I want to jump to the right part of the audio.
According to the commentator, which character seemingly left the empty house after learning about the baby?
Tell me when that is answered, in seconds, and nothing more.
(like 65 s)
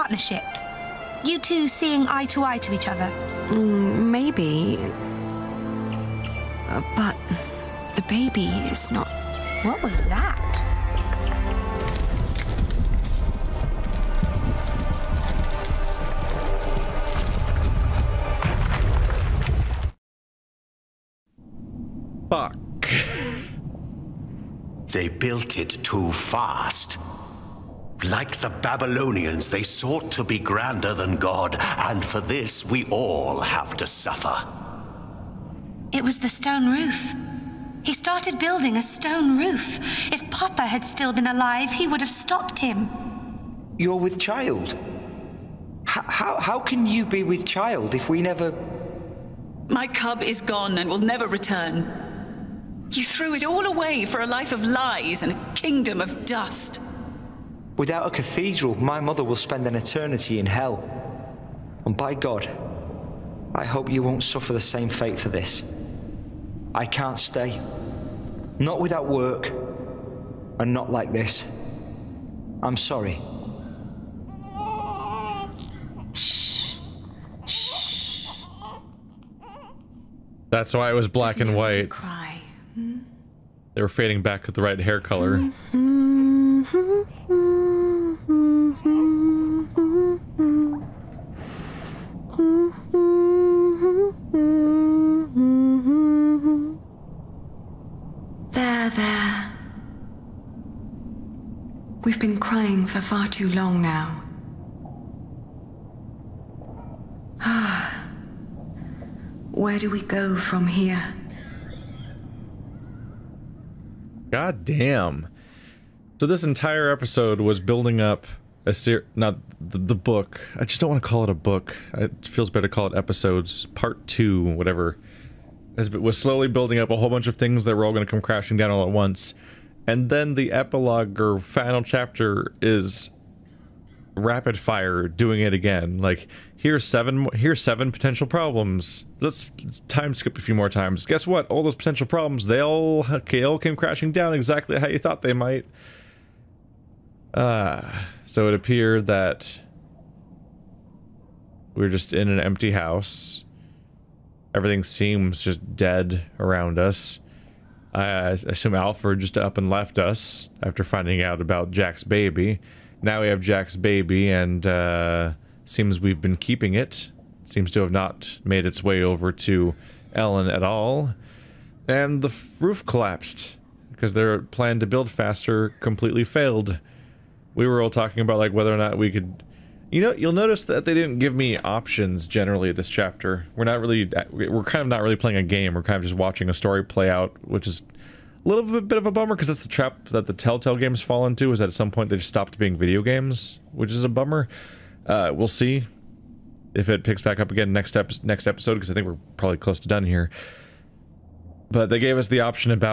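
158 s.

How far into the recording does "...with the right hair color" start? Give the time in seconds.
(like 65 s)
84 s.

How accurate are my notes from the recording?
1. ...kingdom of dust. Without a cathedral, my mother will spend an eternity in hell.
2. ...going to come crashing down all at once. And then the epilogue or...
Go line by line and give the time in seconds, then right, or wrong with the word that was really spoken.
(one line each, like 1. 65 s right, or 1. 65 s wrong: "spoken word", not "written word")
1. 55 s right
2. 127 s right.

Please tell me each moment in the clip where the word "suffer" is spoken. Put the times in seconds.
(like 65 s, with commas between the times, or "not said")
33 s, 64 s.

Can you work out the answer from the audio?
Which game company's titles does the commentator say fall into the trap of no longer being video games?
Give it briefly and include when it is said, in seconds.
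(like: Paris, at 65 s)
Telltale, at 190 s.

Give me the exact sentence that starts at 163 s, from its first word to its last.
Now we have Jack's baby, and uh, seems we've been keeping it.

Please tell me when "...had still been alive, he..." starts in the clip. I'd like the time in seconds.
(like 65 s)
40 s.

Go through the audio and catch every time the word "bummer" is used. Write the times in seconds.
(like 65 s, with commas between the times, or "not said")
189 s, 194 s.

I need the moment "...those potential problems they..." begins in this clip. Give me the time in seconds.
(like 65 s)
141 s.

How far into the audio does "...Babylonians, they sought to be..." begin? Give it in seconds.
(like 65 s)
28 s.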